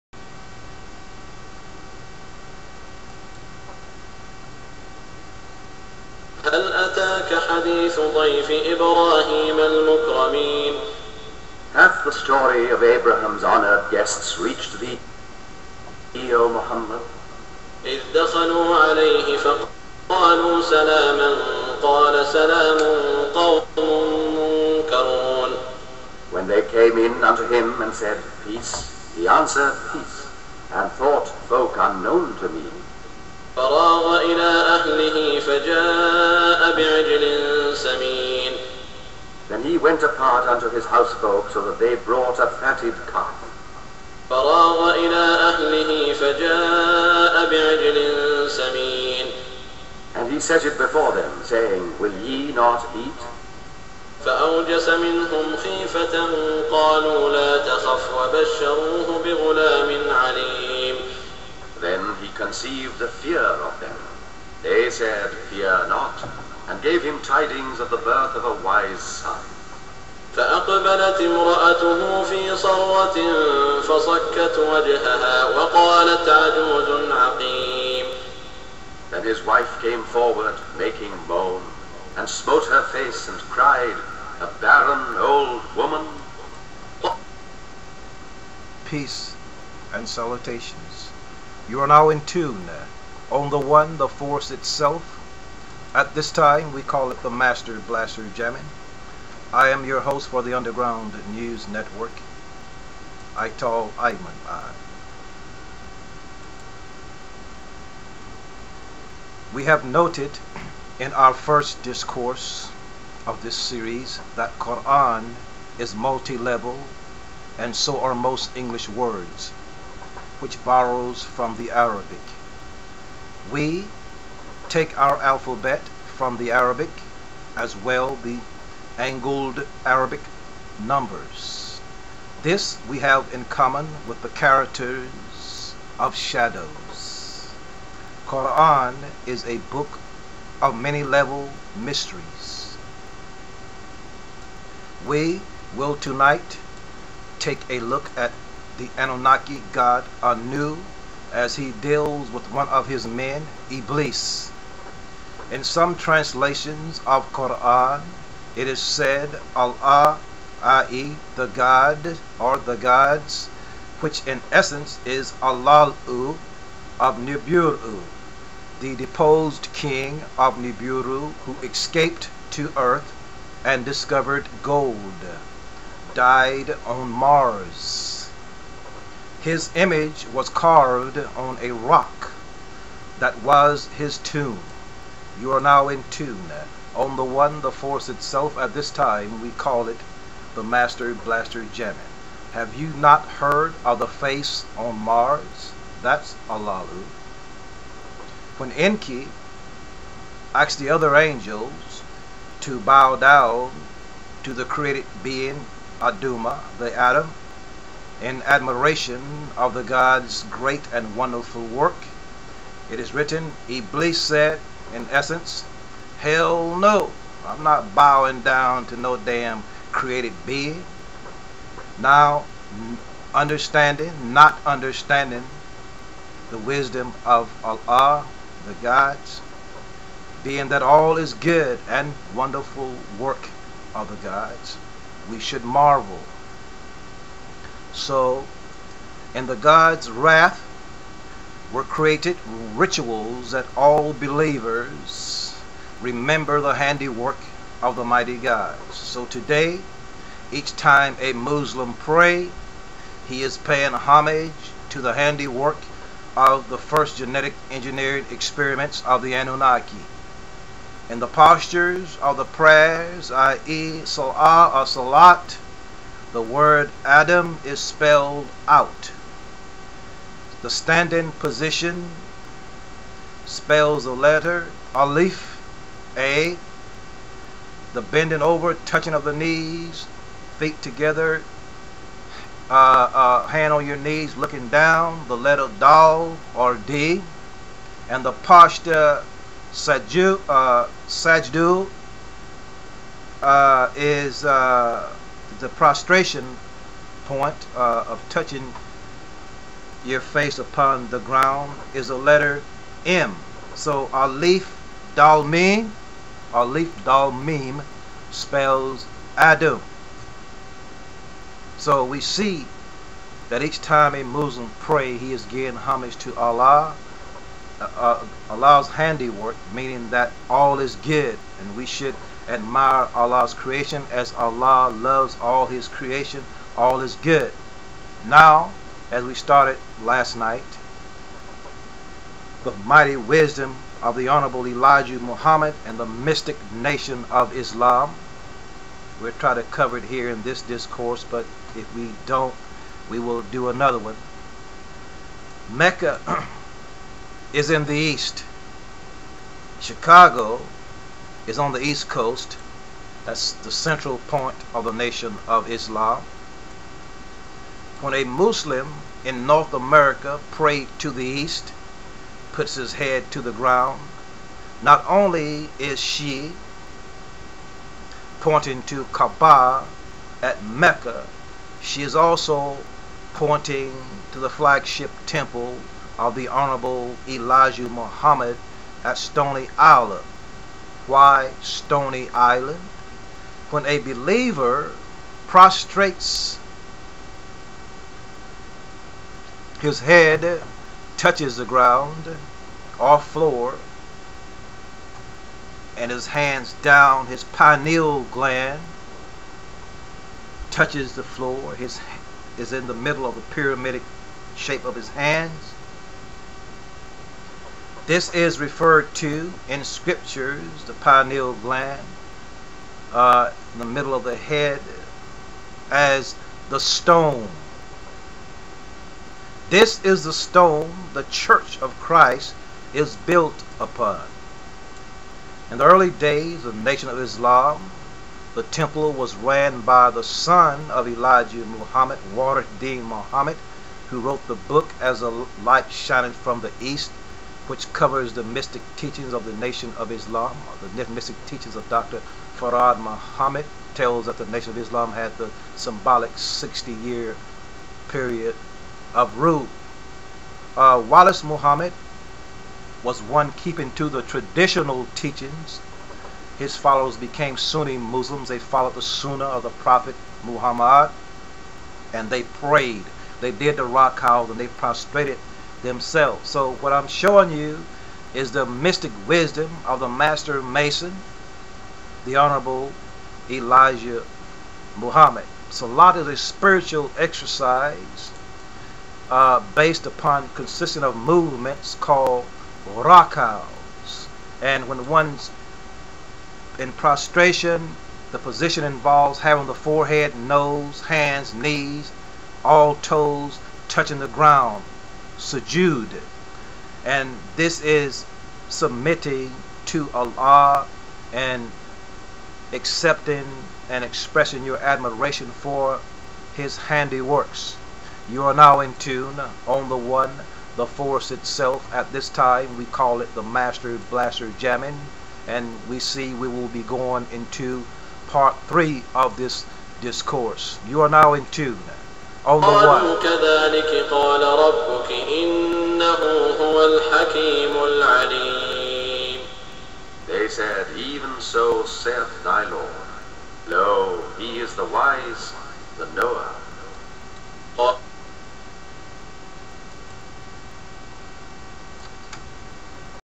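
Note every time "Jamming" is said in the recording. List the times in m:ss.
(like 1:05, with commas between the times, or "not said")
1:38, 3:11, 8:34.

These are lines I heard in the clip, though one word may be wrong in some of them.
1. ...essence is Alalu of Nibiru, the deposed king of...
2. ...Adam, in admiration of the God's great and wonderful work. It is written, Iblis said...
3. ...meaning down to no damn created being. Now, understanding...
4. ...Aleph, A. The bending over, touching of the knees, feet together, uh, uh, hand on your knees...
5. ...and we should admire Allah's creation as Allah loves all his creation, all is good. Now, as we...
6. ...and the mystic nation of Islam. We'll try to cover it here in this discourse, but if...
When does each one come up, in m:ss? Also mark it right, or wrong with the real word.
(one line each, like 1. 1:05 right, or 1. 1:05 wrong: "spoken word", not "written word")
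1. 2:44 right
2. 3:26 right
3. 3:37 wrong: "bowing", not "meaning"
4. 4:34 right
5. 5:21 right
6. 5:35 right.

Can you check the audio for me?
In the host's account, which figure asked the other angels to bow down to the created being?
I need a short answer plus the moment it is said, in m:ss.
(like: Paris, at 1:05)
Enki, at 3:18.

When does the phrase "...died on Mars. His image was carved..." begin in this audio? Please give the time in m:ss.
2:56.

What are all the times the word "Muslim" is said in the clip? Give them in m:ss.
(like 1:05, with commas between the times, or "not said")
4:11, 5:14, 5:58, 7:37.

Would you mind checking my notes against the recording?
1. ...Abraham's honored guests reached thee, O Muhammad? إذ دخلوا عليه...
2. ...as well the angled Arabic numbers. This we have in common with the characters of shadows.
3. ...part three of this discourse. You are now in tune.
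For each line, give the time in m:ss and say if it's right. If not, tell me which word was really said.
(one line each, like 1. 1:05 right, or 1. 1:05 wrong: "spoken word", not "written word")
1. 0:12 right
2. 2:07 right
3. 8:38 right.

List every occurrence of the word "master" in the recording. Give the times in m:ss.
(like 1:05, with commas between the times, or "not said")
1:37, 3:10, 7:50, 8:33.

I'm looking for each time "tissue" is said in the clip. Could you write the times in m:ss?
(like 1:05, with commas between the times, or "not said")
not said.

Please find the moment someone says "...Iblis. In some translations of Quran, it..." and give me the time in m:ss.
2:33.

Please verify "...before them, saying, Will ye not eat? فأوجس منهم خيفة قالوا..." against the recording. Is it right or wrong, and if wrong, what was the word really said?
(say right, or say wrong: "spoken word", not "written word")
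right.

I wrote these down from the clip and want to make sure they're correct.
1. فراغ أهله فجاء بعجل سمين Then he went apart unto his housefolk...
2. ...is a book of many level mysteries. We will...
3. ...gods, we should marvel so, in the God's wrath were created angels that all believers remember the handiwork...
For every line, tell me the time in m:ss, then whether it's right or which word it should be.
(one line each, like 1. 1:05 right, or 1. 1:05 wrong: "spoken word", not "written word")
1. 0:33 right
2. 2:19 right
3. 3:54 wrong: "rituals", not "angels".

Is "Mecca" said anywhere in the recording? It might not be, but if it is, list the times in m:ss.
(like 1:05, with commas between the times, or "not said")
5:45, 6:10.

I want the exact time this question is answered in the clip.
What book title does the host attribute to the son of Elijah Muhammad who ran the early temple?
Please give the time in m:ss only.
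7:14.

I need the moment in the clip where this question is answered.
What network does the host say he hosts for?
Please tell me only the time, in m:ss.
1:40.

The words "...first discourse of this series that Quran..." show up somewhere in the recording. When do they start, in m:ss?
1:51.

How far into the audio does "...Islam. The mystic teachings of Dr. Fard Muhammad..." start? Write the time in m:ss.
7:20.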